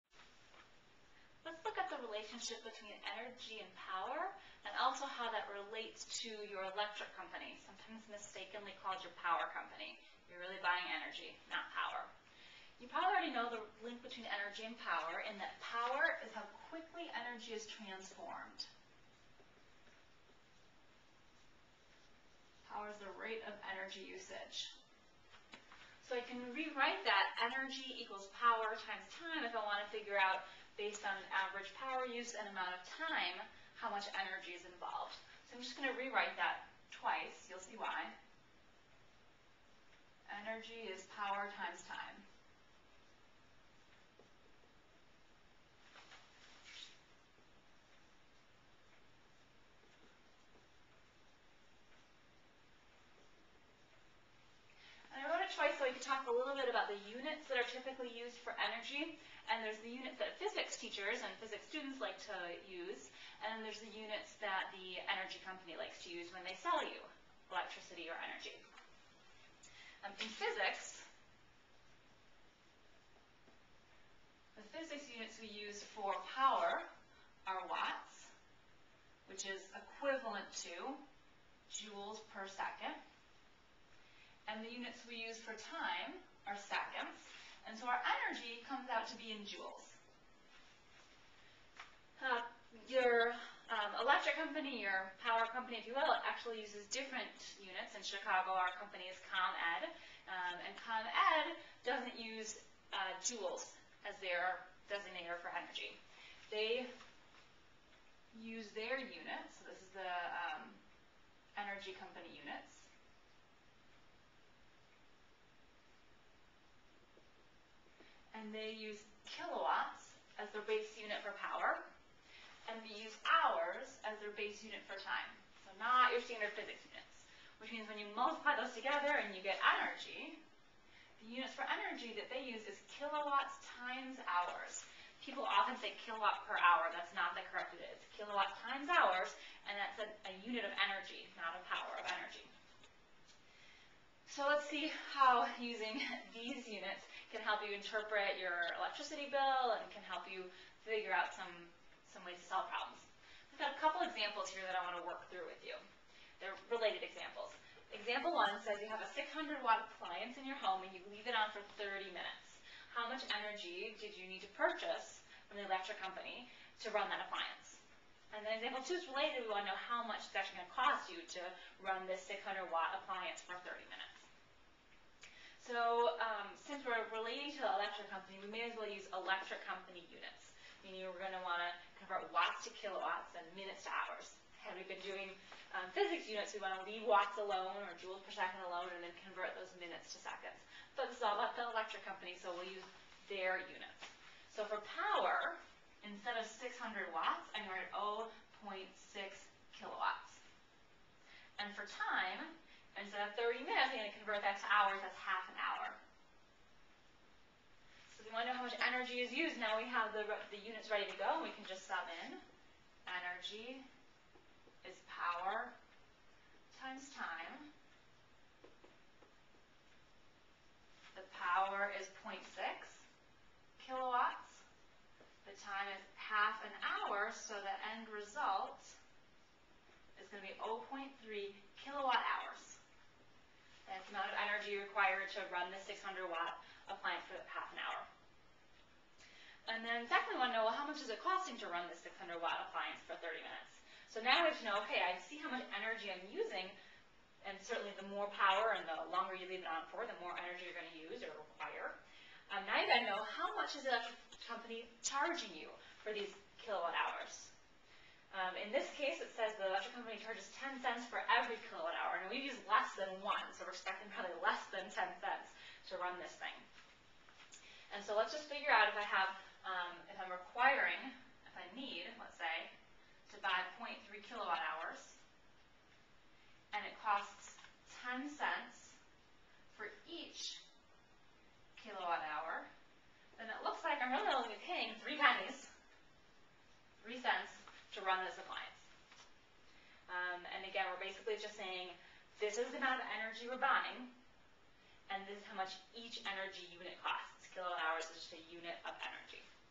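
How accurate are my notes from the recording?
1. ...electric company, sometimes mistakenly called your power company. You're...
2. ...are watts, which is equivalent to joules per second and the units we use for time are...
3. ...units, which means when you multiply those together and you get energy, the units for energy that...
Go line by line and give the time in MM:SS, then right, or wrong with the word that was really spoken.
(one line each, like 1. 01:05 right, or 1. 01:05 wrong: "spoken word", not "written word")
1. 00:06 right
2. 01:17 right
3. 02:06 right.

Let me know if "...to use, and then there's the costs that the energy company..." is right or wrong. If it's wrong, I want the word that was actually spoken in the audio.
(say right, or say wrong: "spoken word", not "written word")
wrong: "units", not "costs".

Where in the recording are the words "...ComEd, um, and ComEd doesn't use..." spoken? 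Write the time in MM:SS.
01:39.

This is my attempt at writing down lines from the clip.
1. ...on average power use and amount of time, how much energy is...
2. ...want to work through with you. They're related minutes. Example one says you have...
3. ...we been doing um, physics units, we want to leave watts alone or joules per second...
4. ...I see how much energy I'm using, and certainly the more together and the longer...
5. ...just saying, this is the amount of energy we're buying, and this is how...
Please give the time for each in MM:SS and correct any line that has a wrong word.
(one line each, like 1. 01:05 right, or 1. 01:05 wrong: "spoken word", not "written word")
1. 00:31 right
2. 02:34 wrong: "examples", not "minutes"
3. 03:04 right
4. 04:05 wrong: "power", not "together"
5. 04:51 right.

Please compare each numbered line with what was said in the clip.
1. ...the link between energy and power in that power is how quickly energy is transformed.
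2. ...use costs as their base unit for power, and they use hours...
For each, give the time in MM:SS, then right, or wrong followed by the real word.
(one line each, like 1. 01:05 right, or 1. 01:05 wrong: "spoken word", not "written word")
1. 00:13 right
2. 01:58 wrong: "kilowatts", not "costs".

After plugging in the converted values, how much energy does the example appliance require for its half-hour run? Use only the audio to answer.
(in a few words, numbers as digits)
0.3 kilowatt hours.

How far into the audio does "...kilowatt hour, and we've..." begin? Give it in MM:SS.
04:21.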